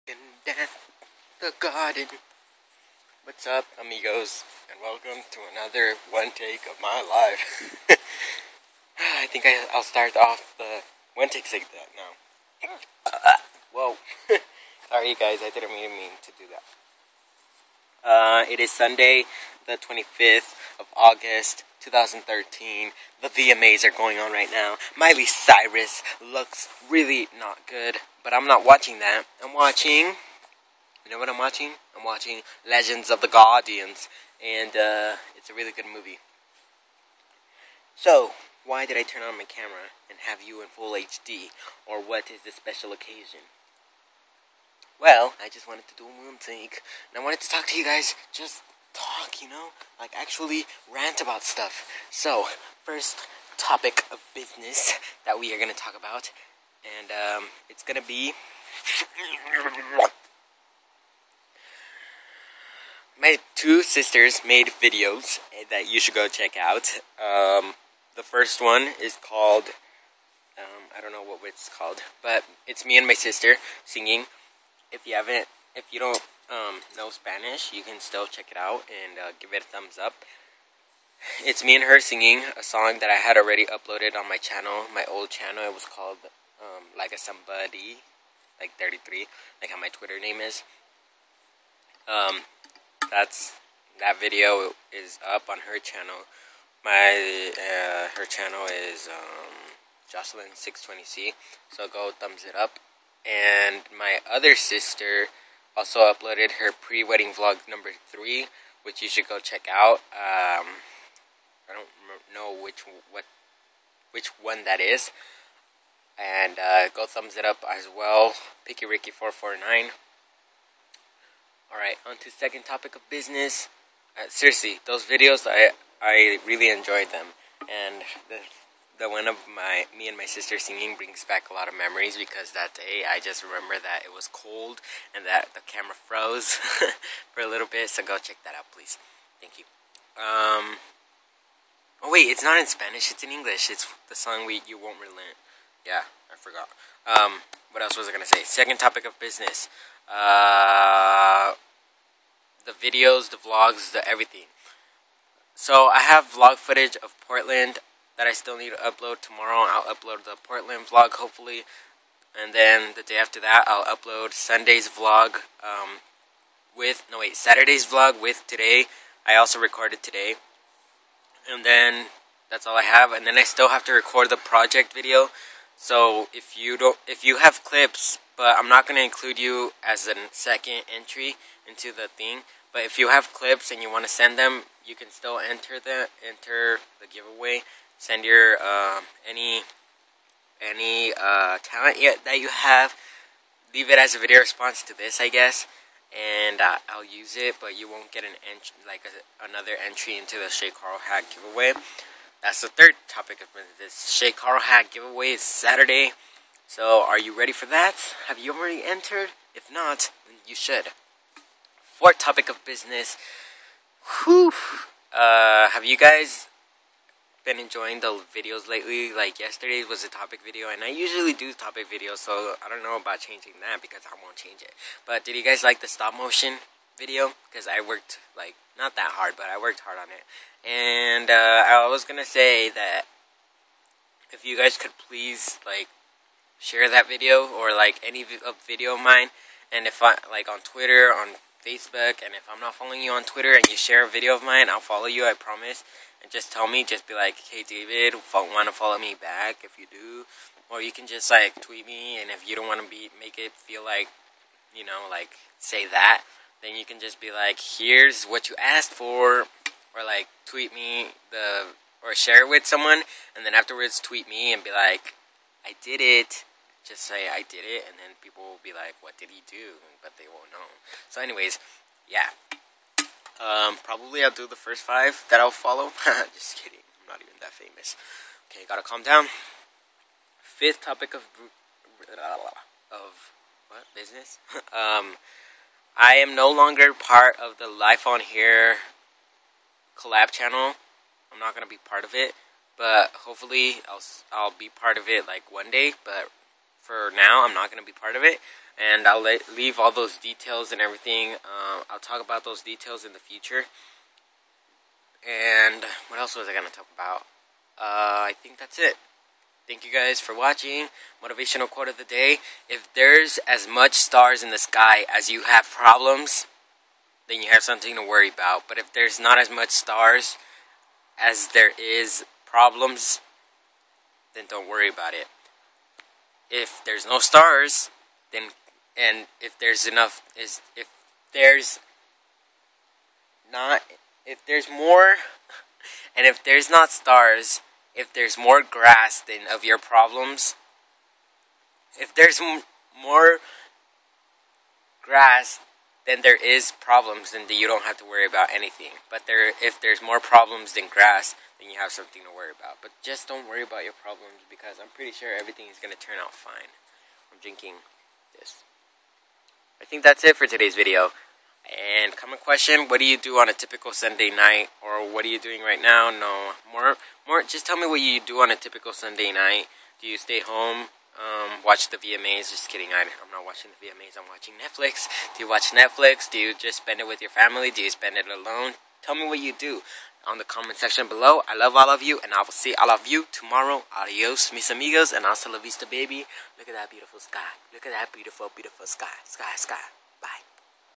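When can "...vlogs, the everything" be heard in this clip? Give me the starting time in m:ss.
2:33.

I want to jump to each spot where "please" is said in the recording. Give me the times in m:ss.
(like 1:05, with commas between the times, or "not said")
2:18, 3:55.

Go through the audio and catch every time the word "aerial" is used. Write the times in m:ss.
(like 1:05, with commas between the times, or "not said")
not said.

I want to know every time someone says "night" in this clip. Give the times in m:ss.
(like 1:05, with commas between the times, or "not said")
6:04, 6:09.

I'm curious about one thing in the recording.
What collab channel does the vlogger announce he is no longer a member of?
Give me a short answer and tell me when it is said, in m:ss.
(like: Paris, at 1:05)
Life on Here, at 4:47.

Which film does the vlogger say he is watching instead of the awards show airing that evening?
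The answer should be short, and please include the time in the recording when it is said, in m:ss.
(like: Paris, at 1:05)
Legends of the Guardians, at 0:32.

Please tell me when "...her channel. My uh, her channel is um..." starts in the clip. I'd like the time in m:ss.
1:35.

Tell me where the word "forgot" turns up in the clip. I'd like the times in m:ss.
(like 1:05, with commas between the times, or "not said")
2:26.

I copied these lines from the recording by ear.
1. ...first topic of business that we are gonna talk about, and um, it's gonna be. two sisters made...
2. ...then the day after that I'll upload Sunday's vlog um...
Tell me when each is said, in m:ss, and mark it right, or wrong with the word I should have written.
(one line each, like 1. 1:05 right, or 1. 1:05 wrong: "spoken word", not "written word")
1. 0:52 right
2. 2:42 right.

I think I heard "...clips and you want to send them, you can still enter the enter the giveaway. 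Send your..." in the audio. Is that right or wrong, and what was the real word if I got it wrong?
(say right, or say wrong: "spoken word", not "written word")
right.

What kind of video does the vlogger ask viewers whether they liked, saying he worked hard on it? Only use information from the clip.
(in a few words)
stop motion.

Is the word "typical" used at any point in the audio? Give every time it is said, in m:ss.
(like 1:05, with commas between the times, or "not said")
6:03, 6:08.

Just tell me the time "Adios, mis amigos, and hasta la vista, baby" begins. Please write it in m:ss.
6:23.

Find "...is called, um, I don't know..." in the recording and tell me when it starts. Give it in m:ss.
1:08.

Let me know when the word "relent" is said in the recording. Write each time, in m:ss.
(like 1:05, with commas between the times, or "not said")
2:24.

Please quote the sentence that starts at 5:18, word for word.
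But if there's not as much stars as there is problems, then don't worry about it.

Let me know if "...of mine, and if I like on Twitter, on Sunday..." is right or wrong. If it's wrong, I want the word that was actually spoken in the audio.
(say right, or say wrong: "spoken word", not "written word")
wrong: "Facebook", not "Sunday".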